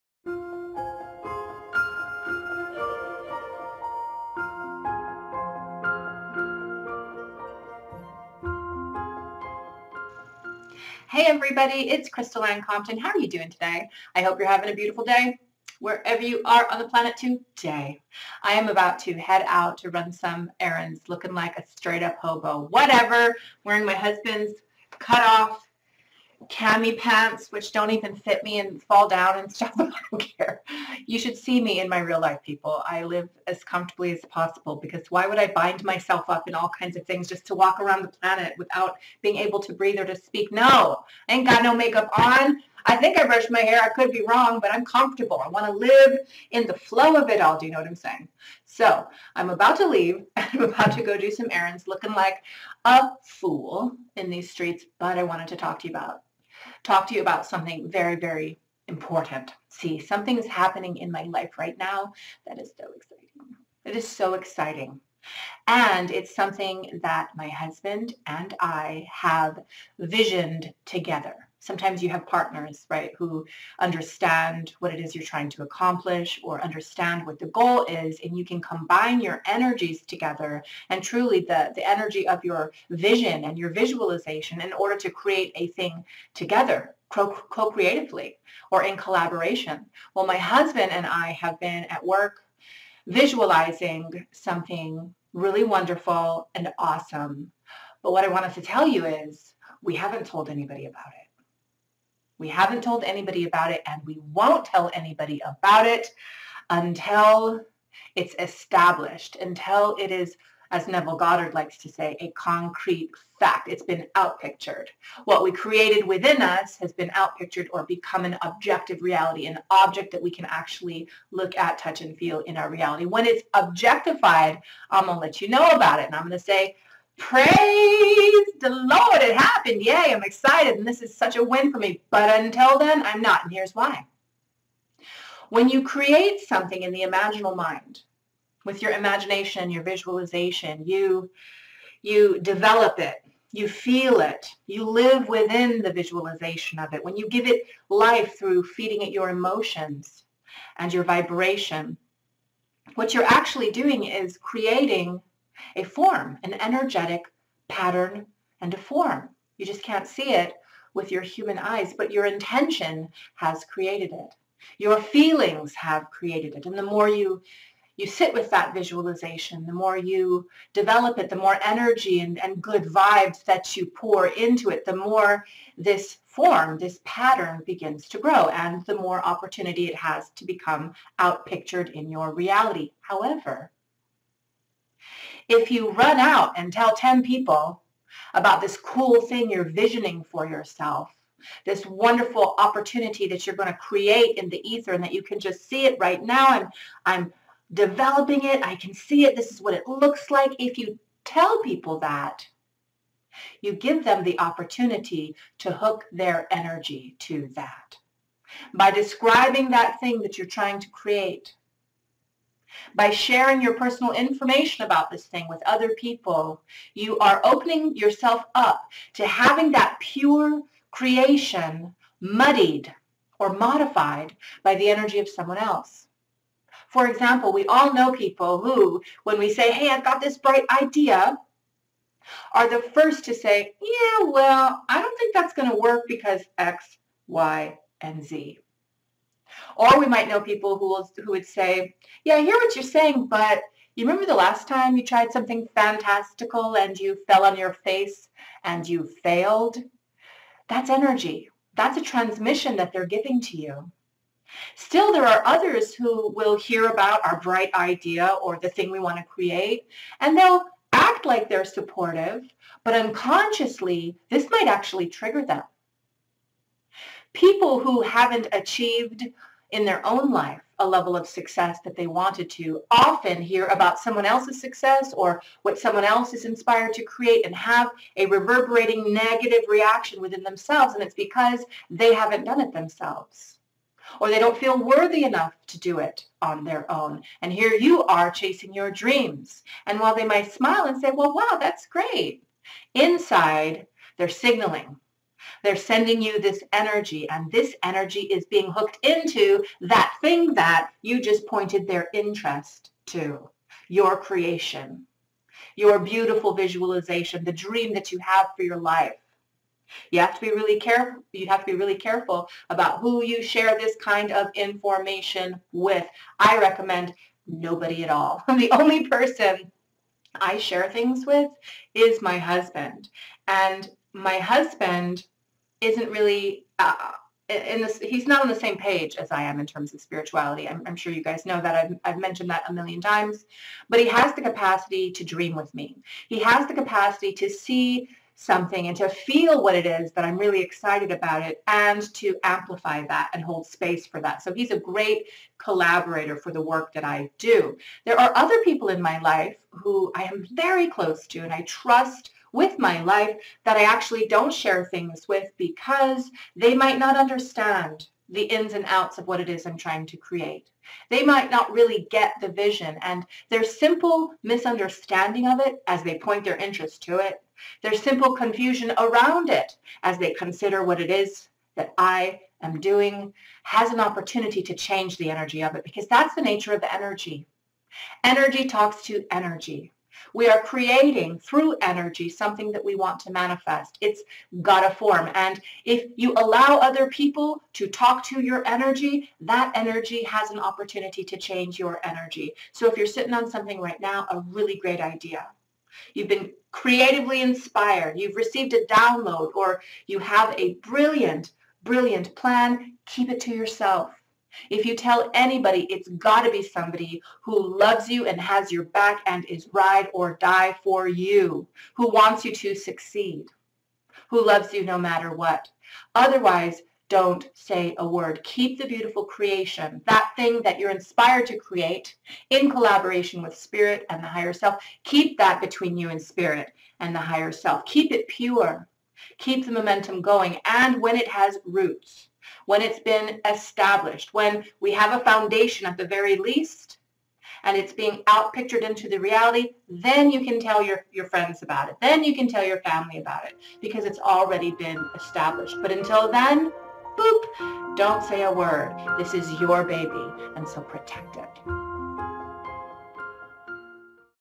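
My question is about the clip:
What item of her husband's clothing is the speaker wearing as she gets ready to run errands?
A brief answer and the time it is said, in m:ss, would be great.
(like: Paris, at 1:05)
cut off cami pants, at 0:24.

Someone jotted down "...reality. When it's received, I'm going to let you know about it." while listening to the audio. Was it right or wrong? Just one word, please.
wrong.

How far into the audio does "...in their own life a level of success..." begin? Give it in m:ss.
4:29.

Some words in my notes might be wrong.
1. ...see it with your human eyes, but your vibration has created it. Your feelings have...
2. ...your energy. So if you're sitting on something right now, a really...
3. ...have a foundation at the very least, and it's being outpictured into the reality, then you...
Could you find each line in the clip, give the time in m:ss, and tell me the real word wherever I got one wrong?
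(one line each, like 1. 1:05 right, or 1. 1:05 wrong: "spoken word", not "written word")
1. 2:40 wrong: "intention", not "vibration"
2. 6:31 right
3. 7:14 right.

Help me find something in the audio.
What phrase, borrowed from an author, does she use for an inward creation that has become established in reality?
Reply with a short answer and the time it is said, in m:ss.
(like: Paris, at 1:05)
concrete fact, at 1:52.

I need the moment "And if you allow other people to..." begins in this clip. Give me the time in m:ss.
6:25.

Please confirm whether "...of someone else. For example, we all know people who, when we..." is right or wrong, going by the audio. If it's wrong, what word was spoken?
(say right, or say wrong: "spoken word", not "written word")
right.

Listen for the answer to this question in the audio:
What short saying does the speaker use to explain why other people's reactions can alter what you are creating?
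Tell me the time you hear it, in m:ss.
6:18.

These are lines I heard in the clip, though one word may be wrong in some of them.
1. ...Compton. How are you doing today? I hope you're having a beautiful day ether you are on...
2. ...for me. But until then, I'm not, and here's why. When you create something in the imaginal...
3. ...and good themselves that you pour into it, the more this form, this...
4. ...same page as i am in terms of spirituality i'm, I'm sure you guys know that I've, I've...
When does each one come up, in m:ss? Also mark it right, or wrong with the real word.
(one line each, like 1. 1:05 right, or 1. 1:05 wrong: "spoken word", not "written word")
1. 0:12 wrong: "wherever", not "ether"
2. 2:11 right
3. 2:52 wrong: "vibes", not "themselves"
4. 5:28 right.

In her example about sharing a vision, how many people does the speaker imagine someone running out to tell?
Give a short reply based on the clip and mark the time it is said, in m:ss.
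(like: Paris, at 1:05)
10, at 3:06.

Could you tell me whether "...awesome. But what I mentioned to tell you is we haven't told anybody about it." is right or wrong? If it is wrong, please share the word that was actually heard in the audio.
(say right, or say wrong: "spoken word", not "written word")
wrong: "wanted", not "mentioned".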